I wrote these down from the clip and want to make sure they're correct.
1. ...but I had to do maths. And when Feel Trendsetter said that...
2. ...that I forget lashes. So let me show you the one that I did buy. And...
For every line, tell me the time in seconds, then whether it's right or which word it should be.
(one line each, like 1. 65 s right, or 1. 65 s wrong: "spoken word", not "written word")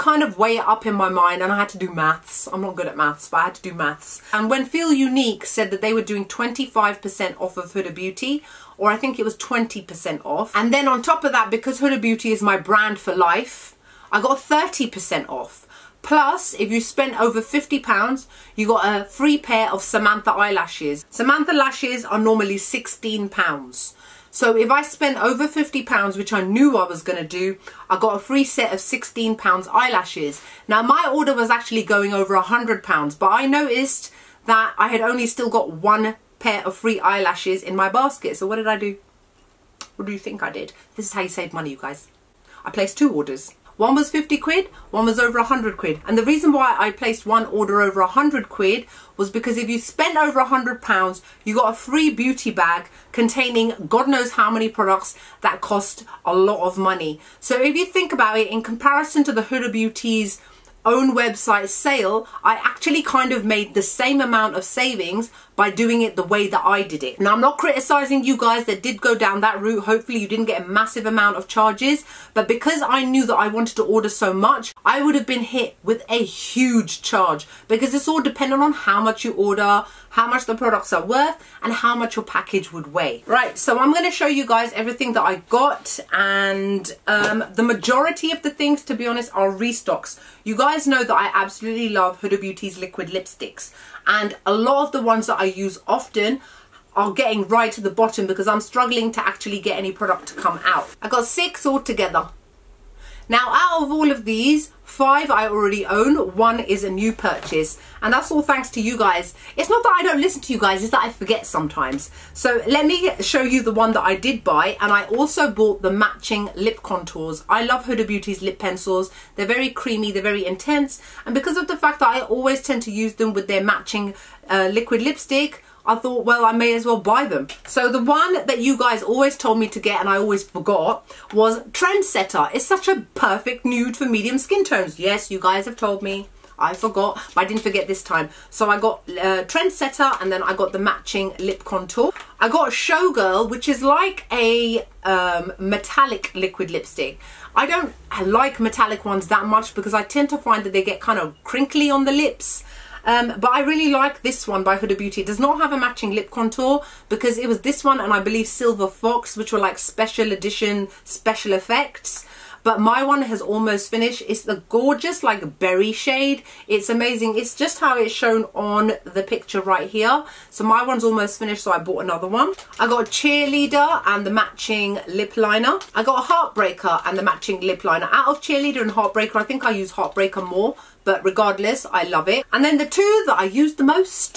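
1. 3 s wrong: "Unique", not "Trendsetter"
2. 110 s wrong: "sometimes", not "lashes".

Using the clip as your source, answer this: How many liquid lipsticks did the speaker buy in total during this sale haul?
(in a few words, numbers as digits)
6.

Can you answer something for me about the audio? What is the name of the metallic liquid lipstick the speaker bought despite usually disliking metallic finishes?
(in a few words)
Showgirl.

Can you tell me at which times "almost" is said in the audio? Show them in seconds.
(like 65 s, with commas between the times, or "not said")
163 s, 171 s.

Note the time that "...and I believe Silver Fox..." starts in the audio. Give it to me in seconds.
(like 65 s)
157 s.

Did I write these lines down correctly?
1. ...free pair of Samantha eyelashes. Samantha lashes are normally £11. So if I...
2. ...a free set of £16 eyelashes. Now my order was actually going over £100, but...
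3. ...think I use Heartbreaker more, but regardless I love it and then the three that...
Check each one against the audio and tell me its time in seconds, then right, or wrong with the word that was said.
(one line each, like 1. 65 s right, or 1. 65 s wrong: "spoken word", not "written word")
1. 19 s wrong: "16", not "11"
2. 28 s right
3. 179 s wrong: "two", not "three".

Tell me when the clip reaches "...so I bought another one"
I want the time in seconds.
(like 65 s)
171 s.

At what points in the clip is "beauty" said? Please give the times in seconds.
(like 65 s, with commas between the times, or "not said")
7 s, 12 s, 52 s, 59 s, 92 s, 118 s, 154 s.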